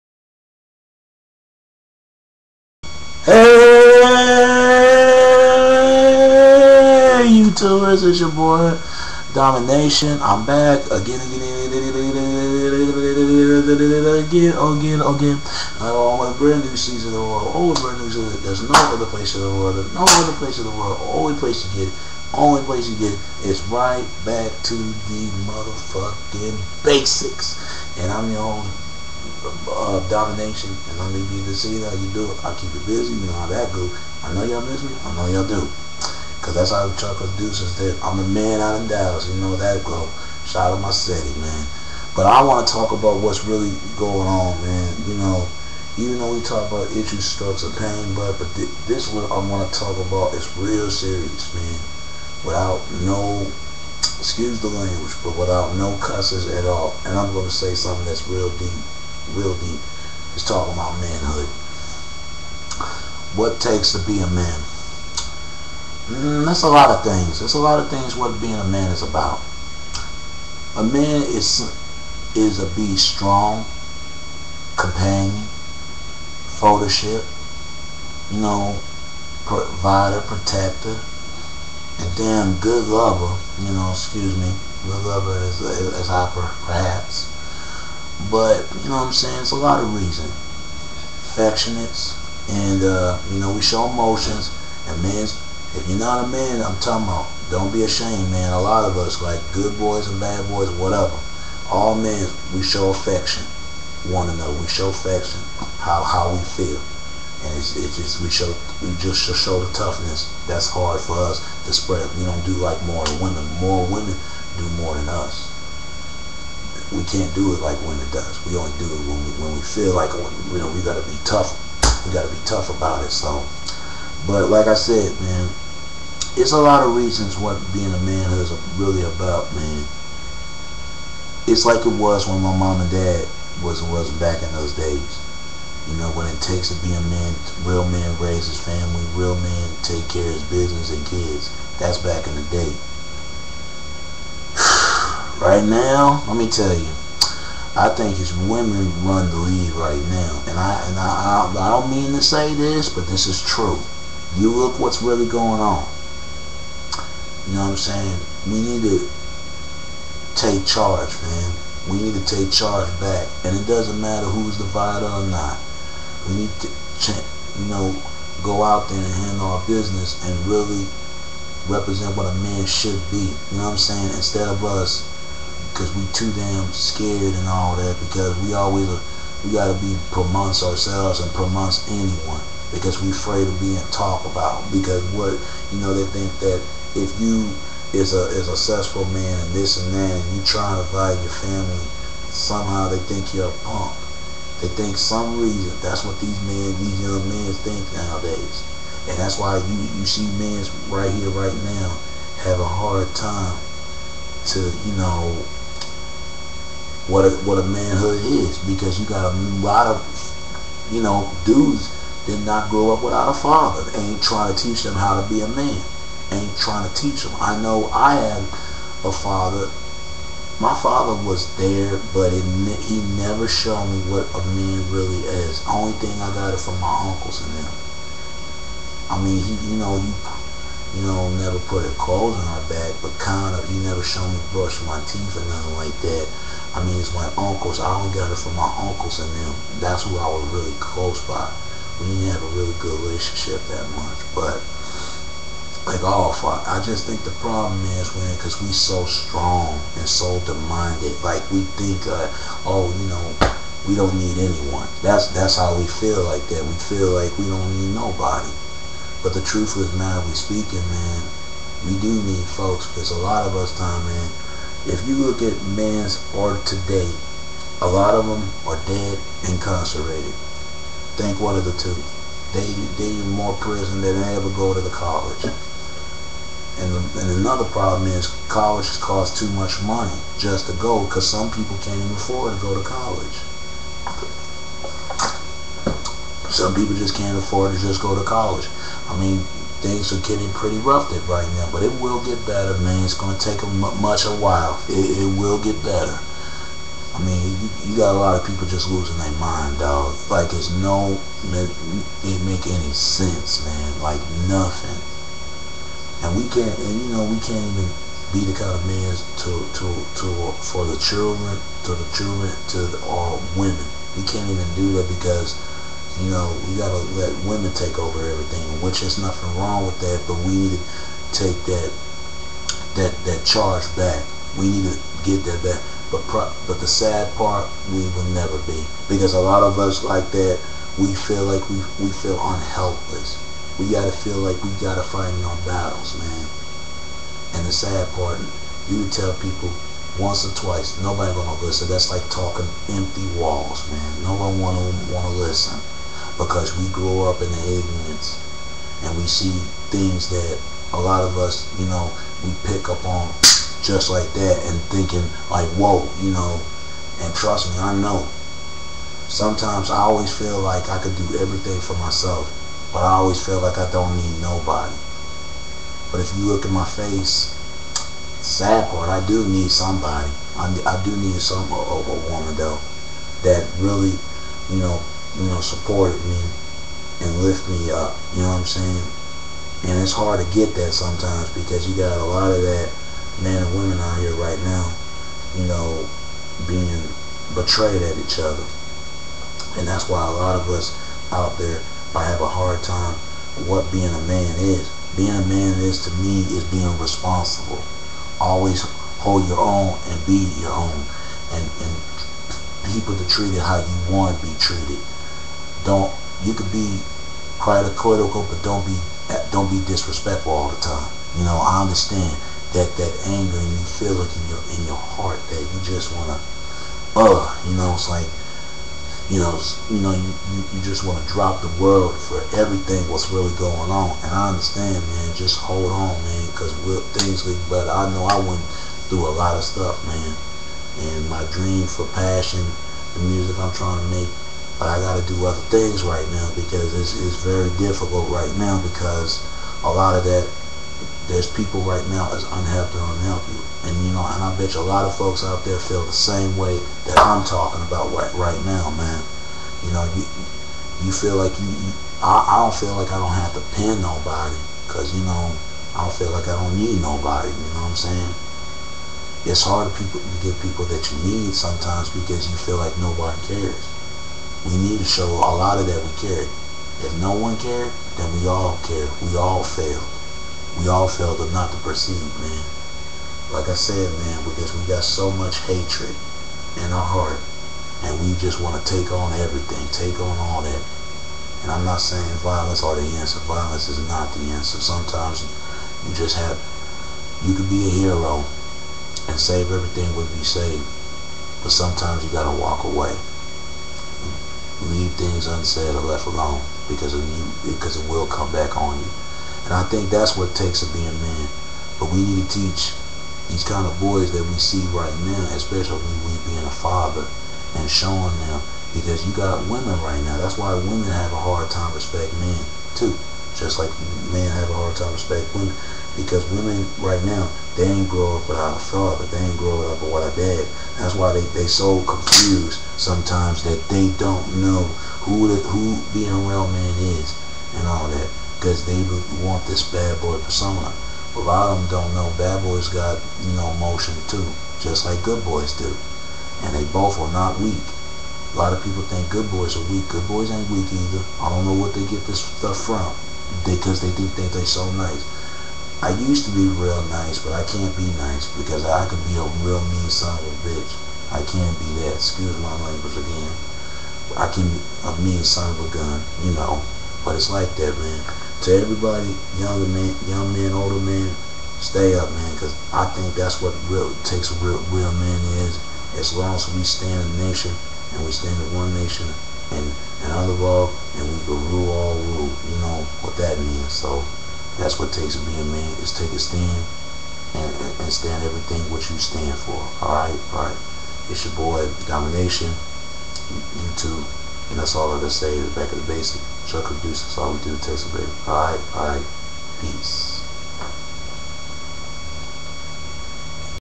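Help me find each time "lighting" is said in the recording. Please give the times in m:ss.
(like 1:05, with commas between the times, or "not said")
not said.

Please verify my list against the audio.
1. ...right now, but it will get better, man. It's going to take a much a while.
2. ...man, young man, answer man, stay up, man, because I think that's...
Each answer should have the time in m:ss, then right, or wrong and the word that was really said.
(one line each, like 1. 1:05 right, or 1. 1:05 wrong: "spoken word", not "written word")
1. 4:51 right
2. 9:19 wrong: "older", not "answer".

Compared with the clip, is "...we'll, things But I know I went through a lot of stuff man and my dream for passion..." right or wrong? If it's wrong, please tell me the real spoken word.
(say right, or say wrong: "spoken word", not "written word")
right.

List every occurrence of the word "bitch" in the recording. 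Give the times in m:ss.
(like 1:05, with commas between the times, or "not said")
9:10.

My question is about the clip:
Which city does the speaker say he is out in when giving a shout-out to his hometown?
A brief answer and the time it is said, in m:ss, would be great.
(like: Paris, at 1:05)
Dallas, at 0:38.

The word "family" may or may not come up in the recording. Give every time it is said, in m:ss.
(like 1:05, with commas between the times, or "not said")
2:18, 3:11.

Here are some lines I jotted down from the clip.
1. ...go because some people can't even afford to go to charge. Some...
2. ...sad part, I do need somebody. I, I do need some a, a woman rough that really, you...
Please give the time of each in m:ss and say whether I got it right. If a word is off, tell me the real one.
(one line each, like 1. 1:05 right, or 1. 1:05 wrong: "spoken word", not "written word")
1. 4:40 wrong: "college", not "charge"
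2. 6:08 wrong: "though", not "rough".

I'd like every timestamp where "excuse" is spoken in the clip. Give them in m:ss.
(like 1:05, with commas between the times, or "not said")
0:54, 1:23, 9:12.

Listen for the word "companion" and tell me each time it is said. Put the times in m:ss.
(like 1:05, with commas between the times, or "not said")
1:14.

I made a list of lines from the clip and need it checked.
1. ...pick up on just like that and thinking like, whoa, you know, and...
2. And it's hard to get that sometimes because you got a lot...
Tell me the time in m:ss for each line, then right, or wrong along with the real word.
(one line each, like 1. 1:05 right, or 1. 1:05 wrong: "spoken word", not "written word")
1. 5:52 right
2. 6:19 right.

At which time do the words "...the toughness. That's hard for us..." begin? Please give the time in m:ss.
1:49.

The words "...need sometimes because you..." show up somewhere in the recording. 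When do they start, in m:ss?
7:41.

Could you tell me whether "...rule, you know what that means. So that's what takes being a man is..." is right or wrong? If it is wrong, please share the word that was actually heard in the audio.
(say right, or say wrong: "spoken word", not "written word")
right.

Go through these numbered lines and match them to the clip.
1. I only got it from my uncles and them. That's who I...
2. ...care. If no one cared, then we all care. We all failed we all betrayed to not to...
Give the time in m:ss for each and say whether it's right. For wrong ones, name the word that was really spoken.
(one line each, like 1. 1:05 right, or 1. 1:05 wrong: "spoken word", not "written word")
1. 3:57 right
2. 7:46 wrong: "failed", not "betrayed".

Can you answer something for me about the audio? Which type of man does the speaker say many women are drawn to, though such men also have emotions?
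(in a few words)
Bad boy persona.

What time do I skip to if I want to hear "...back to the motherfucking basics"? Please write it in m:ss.
0:24.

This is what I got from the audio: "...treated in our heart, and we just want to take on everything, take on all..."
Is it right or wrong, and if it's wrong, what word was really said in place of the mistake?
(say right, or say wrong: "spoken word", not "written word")
wrong: "hatred", not "treated".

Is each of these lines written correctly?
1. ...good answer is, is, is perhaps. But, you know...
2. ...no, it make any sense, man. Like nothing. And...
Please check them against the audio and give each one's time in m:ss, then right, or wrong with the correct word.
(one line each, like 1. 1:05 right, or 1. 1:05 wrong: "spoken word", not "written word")
1. 1:24 wrong: "lover", not "answer"
2. 5:00 right.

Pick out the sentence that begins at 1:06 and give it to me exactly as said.
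Mm, that's a lot of things.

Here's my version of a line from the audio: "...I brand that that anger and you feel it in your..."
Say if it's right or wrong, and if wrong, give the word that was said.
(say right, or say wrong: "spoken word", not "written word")
wrong: "understand", not "brand".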